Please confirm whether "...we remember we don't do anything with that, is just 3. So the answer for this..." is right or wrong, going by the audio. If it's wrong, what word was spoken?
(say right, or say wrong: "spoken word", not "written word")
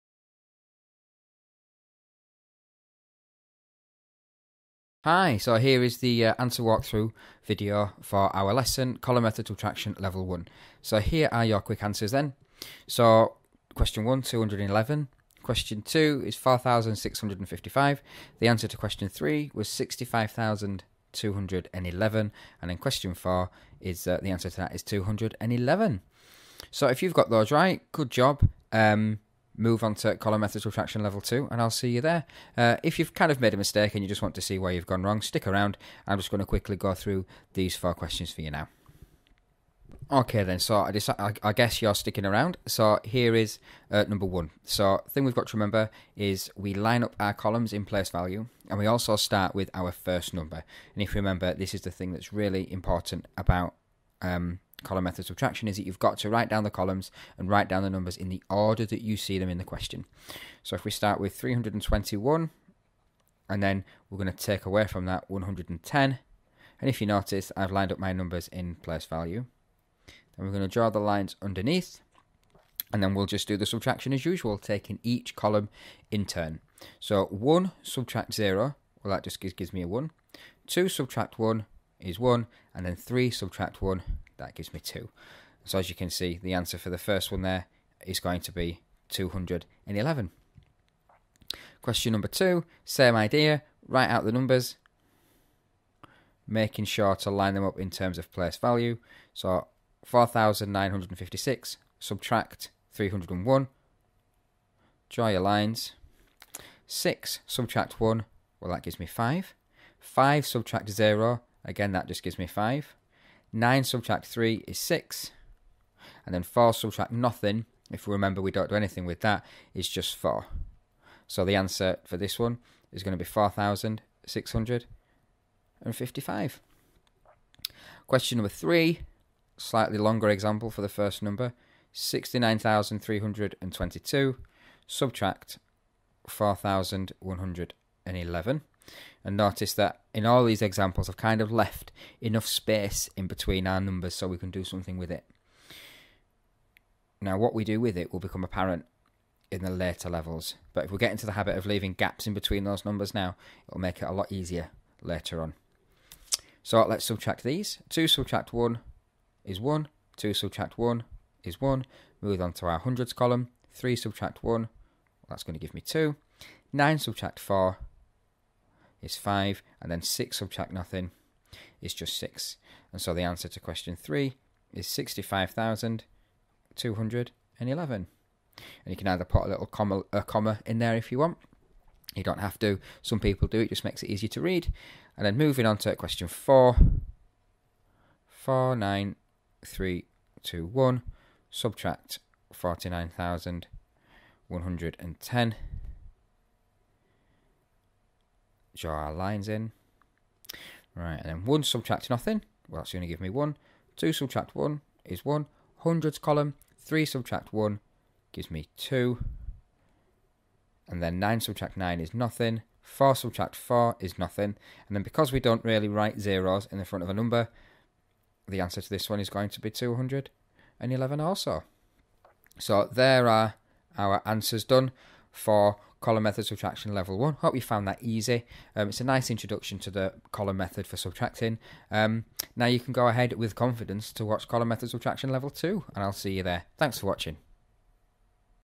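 wrong: "4", not "3".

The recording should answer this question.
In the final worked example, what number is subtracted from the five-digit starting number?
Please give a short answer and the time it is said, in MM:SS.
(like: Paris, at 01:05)
49,110, at 03:12.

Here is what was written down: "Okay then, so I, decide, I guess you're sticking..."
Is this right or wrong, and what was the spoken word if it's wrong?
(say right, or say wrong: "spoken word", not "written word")
right.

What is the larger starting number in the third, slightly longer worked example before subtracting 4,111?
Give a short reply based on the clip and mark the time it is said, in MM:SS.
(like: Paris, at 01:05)
69,322, at 02:11.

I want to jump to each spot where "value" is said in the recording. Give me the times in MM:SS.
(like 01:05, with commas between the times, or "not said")
00:48, 01:09, 01:38.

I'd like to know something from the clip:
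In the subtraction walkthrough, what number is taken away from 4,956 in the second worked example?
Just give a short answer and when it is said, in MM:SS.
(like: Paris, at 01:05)
301, at 01:42.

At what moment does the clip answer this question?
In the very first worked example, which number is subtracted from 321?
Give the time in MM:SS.
01:05.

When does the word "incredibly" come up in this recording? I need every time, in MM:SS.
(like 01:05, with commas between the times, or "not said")
not said.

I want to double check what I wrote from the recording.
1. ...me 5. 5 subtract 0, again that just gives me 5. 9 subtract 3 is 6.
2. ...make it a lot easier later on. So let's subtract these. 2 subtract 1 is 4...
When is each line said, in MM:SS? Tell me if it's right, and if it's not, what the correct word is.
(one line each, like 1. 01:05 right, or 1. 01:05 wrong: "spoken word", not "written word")
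1. 01:48 right
2. 02:33 wrong: "1", not "4".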